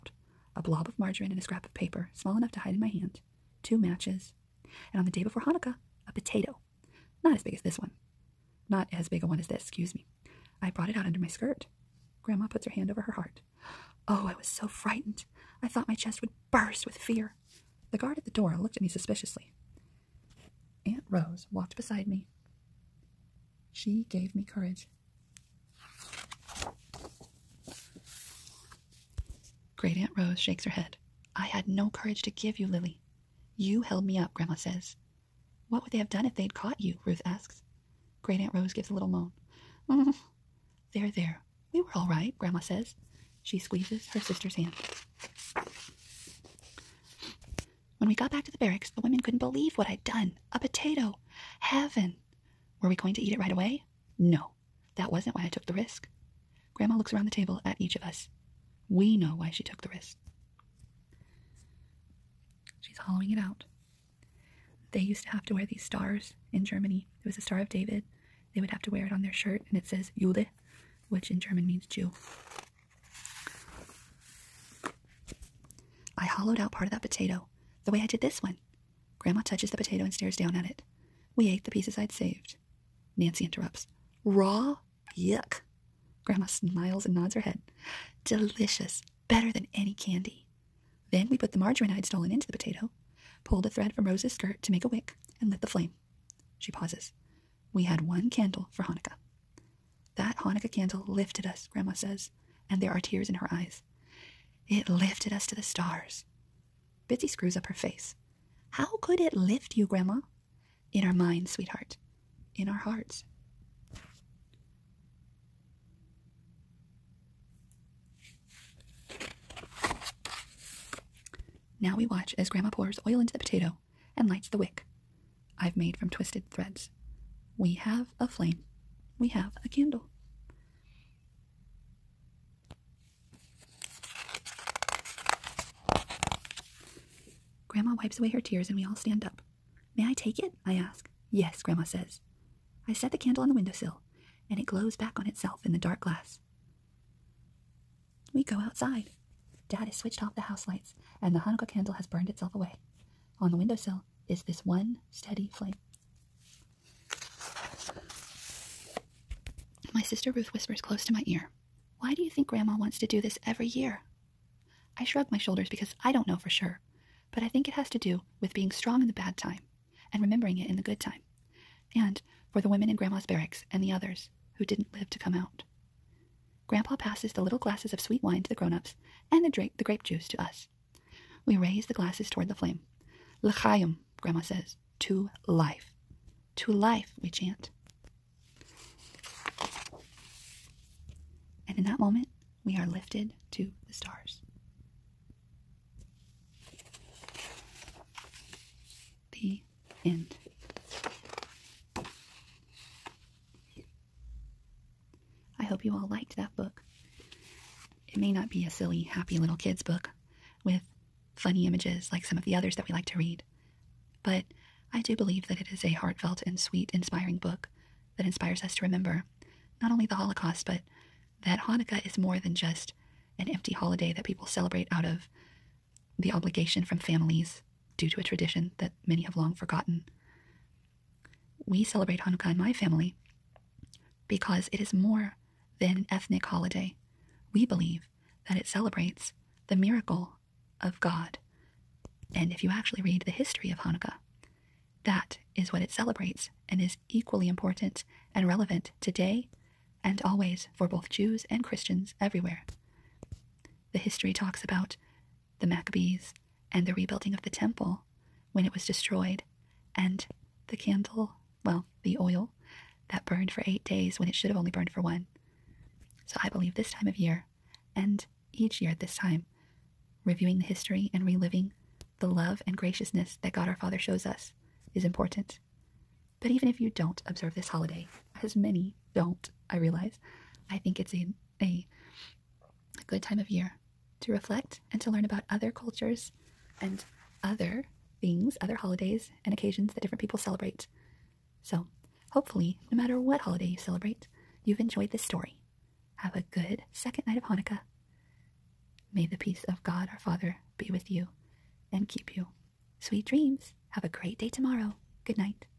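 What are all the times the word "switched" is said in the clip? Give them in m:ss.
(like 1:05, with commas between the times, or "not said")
2:29.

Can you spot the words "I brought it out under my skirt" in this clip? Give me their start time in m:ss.
0:10.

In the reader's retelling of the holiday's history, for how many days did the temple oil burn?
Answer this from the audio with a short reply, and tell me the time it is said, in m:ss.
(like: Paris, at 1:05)
8, at 4:23.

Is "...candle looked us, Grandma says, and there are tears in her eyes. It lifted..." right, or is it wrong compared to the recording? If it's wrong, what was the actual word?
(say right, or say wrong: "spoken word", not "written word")
wrong: "lifted", not "looked".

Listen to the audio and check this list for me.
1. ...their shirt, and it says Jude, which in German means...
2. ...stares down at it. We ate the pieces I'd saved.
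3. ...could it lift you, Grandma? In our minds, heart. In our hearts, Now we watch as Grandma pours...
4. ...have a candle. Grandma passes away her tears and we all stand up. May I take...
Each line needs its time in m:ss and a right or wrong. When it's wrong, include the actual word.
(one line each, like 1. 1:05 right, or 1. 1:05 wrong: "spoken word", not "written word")
1. 1:09 right
2. 1:20 right
3. 1:49 wrong: "sweetheart", not "heart"
4. 2:09 wrong: "wipes", not "passes".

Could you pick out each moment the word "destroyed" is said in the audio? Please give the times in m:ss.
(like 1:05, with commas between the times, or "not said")
4:18.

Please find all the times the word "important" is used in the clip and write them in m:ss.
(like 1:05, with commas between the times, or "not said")
4:07, 4:35.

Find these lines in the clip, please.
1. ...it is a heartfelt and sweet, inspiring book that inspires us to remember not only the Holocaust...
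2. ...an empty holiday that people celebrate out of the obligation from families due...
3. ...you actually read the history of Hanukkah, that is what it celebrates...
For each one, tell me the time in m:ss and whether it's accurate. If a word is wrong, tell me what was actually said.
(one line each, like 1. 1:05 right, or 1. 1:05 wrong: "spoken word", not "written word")
1. 3:35 right
2. 3:43 right
3. 4:02 right.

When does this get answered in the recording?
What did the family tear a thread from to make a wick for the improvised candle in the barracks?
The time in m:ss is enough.
1:34.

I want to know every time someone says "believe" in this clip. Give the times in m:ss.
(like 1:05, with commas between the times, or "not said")
0:49, 3:35, 3:57, 4:26.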